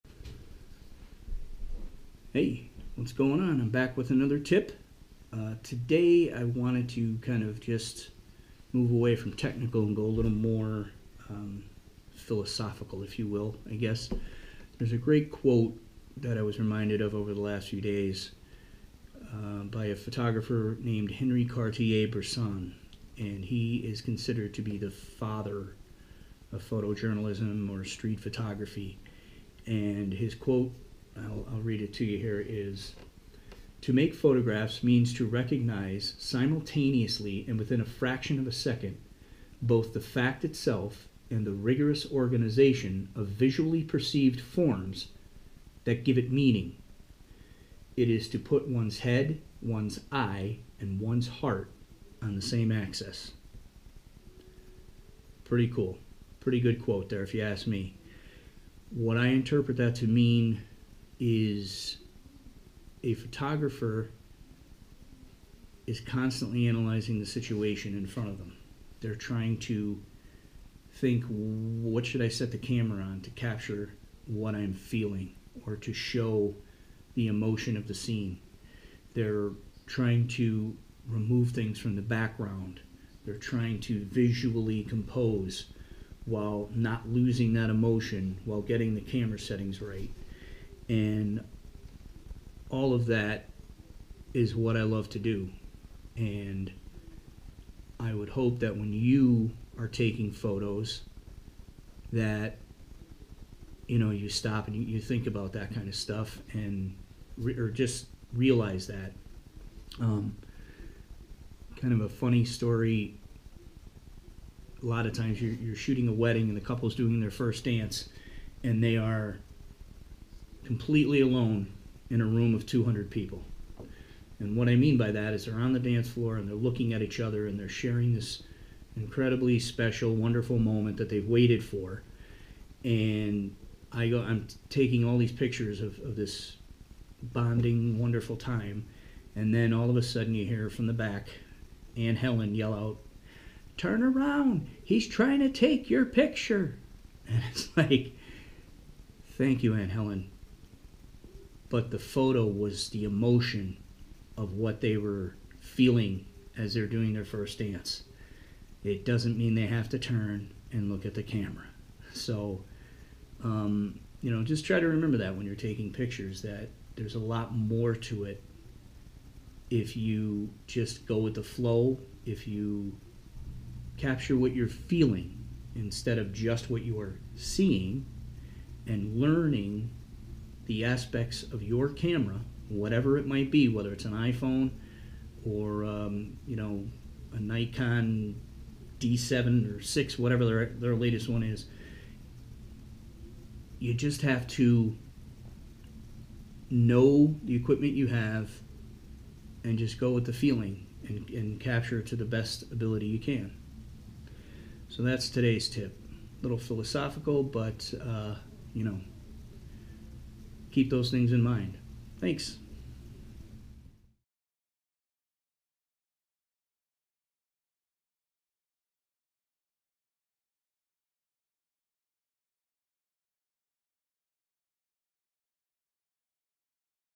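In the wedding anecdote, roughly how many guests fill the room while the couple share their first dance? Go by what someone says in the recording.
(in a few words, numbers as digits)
200.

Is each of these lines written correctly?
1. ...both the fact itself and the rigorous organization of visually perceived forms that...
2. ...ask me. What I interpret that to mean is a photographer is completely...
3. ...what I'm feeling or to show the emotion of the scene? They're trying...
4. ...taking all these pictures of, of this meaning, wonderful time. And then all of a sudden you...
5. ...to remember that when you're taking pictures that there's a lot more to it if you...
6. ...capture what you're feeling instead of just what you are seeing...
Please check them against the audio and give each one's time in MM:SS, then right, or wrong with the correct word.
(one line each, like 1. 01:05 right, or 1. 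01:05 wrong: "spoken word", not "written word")
1. 00:39 right
2. 00:57 wrong: "constantly", not "completely"
3. 01:14 right
4. 02:14 wrong: "bonding", not "meaning"
5. 02:44 right
6. 02:53 right.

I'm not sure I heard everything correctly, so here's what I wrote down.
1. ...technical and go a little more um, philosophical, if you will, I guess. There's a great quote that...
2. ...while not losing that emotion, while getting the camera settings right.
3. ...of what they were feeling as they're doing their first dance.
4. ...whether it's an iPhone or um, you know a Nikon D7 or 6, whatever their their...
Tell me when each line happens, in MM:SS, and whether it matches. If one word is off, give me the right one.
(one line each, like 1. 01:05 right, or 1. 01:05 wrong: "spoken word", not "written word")
1. 00:09 right
2. 01:26 right
3. 02:34 right
4. 03:03 right.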